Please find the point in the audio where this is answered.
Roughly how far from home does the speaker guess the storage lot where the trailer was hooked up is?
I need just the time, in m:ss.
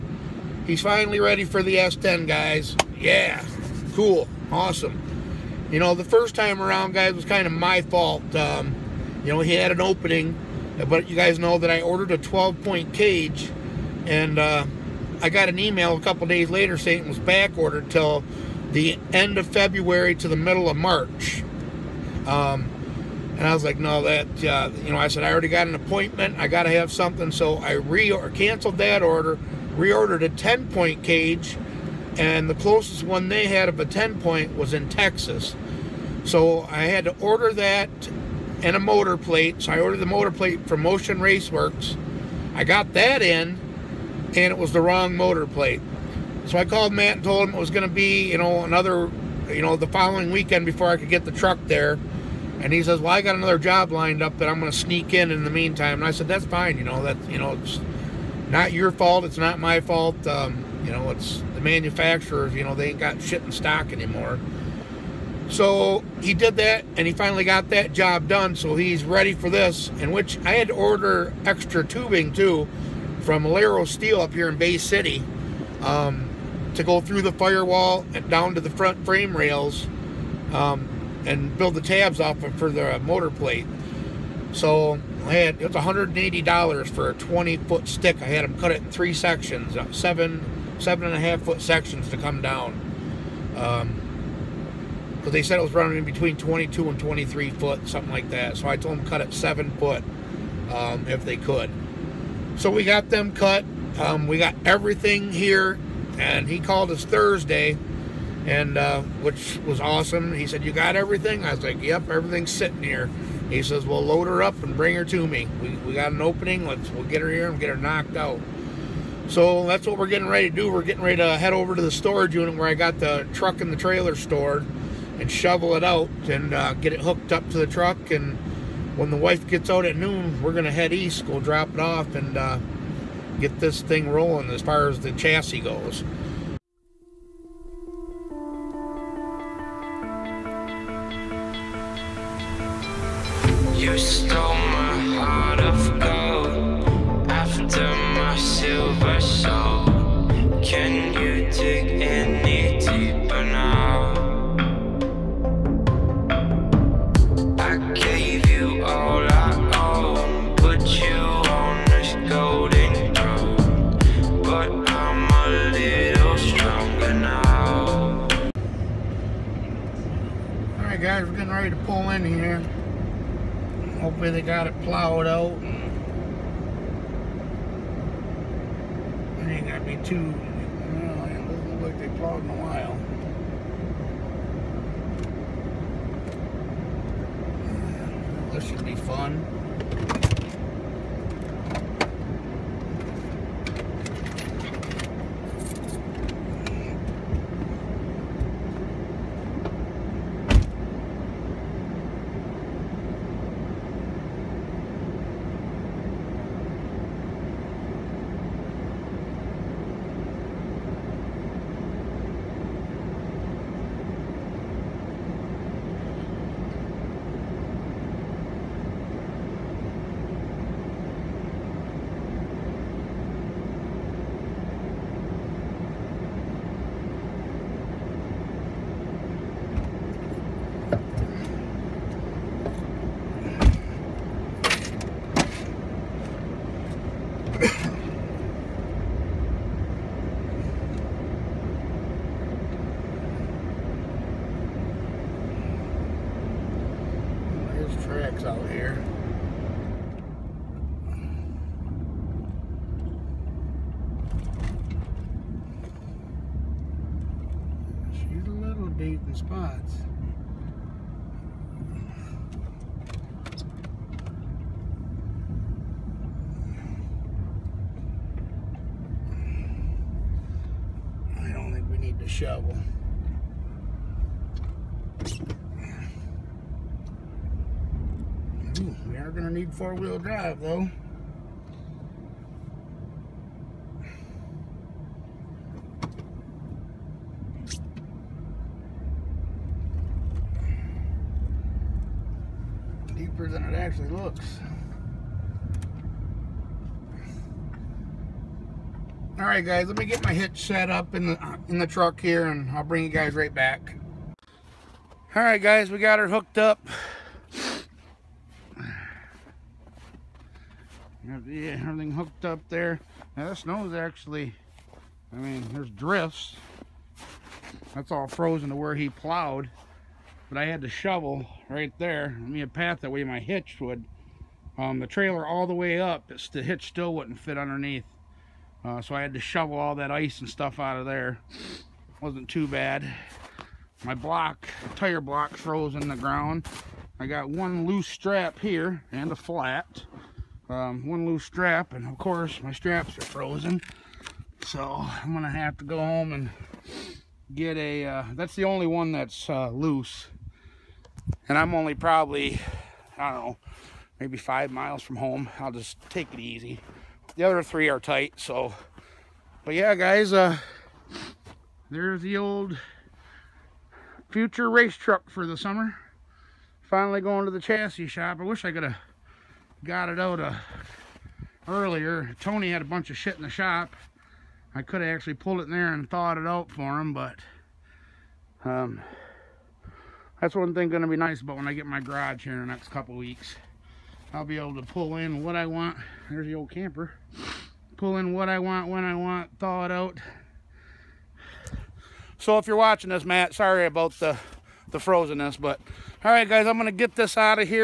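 5:54.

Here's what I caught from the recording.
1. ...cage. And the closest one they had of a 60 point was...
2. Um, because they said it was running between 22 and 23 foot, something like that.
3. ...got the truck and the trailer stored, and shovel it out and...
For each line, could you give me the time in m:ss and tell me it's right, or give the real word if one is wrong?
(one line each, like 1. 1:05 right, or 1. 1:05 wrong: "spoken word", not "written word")
1. 0:31 wrong: "10", not "60"
2. 1:33 right
3. 2:02 right.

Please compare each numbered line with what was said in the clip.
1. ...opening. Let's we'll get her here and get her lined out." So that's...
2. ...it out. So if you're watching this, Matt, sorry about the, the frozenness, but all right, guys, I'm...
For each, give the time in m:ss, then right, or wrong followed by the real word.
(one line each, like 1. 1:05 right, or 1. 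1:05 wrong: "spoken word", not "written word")
1. 1:56 wrong: "knocked", not "lined"
2. 6:29 right.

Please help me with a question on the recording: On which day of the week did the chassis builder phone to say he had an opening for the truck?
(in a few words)
Thursday.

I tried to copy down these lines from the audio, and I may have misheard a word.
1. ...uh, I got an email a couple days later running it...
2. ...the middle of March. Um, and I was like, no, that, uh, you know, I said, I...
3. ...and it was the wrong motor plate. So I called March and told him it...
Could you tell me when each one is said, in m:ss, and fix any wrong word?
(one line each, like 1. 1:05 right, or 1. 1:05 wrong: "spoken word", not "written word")
1. 0:14 wrong: "saying", not "running"
2. 0:20 right
3. 0:44 wrong: "Matt", not "March".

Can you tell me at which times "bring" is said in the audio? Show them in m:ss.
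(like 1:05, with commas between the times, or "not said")
1:54, 5:02.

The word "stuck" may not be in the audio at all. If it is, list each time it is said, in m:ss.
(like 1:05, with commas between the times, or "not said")
not said.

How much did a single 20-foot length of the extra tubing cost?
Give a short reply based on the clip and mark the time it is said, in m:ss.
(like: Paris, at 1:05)
$180, at 1:25.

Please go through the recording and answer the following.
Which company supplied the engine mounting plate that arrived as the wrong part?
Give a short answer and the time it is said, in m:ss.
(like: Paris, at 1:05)
Motion Raceworks, at 0:40.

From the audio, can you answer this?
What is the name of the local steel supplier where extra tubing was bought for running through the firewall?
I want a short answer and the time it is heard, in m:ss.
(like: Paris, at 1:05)
Alero Steel, at 1:13.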